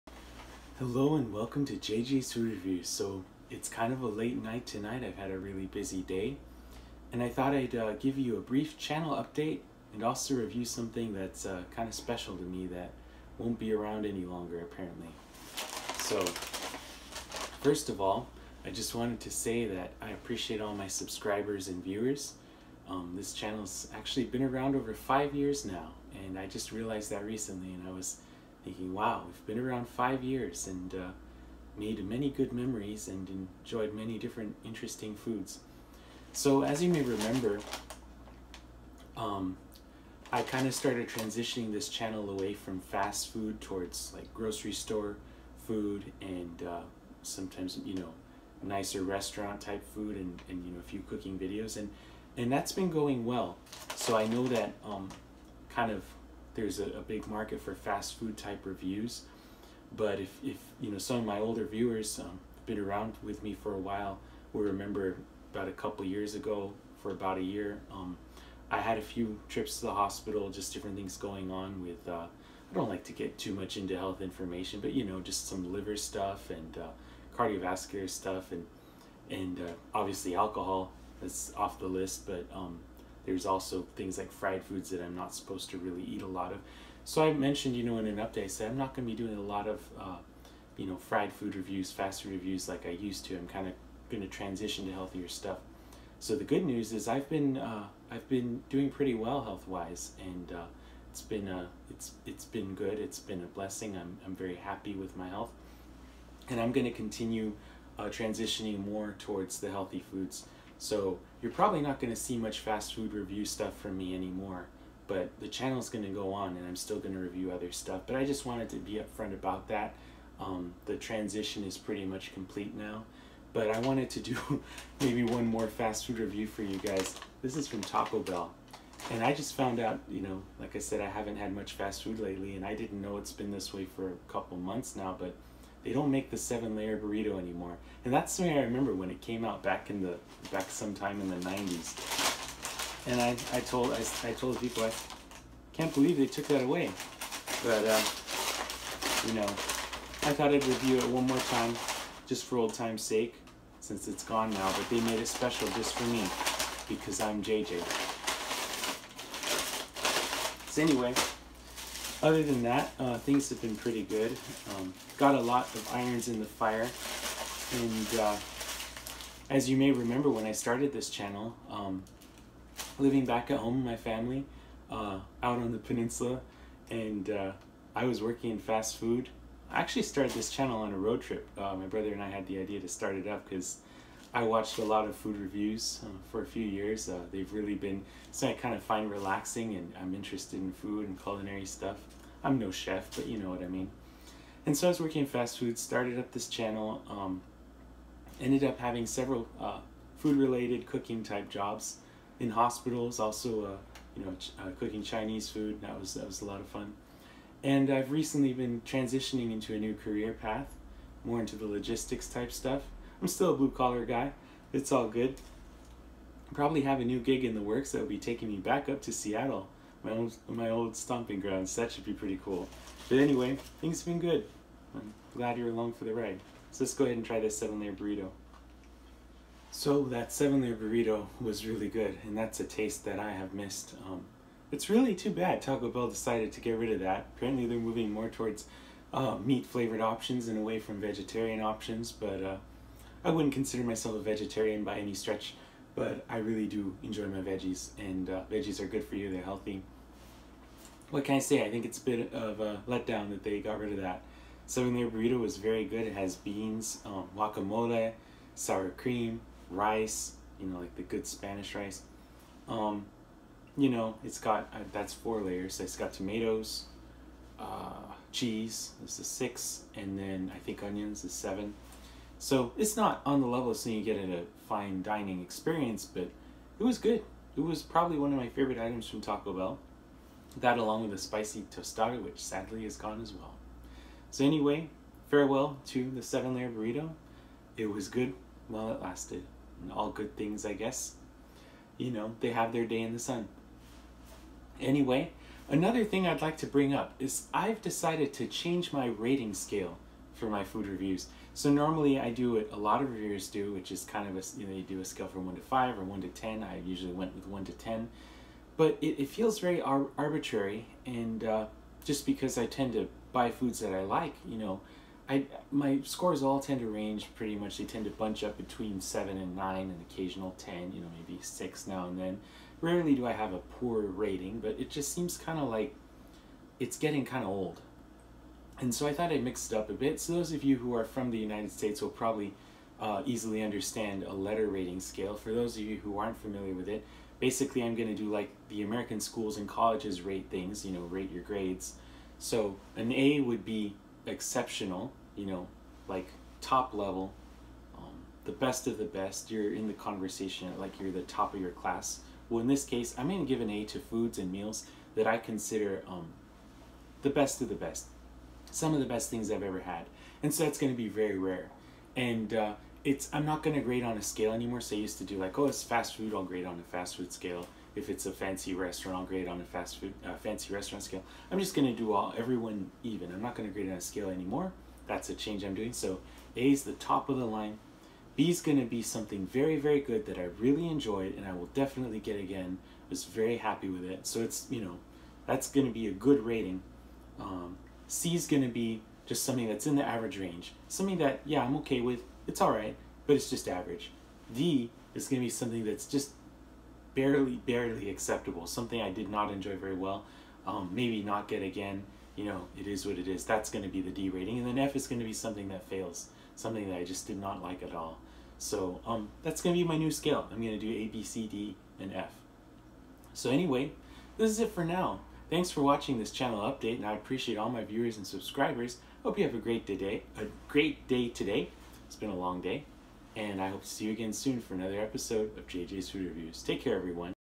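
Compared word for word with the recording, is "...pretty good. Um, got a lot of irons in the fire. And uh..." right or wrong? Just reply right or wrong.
right.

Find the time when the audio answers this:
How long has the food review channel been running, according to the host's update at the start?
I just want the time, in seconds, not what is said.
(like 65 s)
24 s.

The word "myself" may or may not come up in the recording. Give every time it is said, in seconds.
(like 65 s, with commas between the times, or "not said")
243 s.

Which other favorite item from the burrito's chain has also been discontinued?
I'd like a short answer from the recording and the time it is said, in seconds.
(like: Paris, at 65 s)
Spicy tostada, at 281 s.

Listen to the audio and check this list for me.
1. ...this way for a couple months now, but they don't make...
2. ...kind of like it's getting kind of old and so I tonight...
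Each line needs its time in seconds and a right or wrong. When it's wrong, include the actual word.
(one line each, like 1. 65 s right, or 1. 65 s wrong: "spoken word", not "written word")
1. 133 s right
2. 325 s wrong: "thought", not "tonight".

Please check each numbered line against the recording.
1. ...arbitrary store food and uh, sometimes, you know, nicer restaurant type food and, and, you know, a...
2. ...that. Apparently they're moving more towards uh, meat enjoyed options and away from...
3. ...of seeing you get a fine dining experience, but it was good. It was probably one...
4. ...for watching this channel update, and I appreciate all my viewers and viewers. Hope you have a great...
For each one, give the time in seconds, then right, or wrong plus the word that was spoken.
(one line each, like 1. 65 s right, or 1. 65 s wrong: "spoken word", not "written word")
1. 44 s wrong: "grocery", not "arbitrary"
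2. 237 s wrong: "flavored", not "enjoyed"
3. 273 s right
4. 415 s wrong: "subscribers", not "viewers".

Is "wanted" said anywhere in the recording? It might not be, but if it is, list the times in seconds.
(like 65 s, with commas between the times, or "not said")
18 s, 118 s, 123 s.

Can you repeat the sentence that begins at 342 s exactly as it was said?
So an A would be exceptional, you know, like top level, um, the best of the best.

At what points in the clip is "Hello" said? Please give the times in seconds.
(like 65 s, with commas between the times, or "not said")
0 s.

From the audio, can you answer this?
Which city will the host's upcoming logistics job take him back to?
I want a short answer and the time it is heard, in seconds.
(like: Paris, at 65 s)
Seattle, at 219 s.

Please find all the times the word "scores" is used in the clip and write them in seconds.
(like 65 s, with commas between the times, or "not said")
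316 s.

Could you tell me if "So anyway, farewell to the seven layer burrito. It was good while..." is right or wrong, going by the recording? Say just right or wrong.
right.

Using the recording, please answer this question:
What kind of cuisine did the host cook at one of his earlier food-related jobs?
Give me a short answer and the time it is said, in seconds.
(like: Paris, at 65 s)
Chinese food, at 205 s.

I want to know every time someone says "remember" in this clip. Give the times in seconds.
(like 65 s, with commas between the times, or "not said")
37 s, 64 s, 138 s, 169 s.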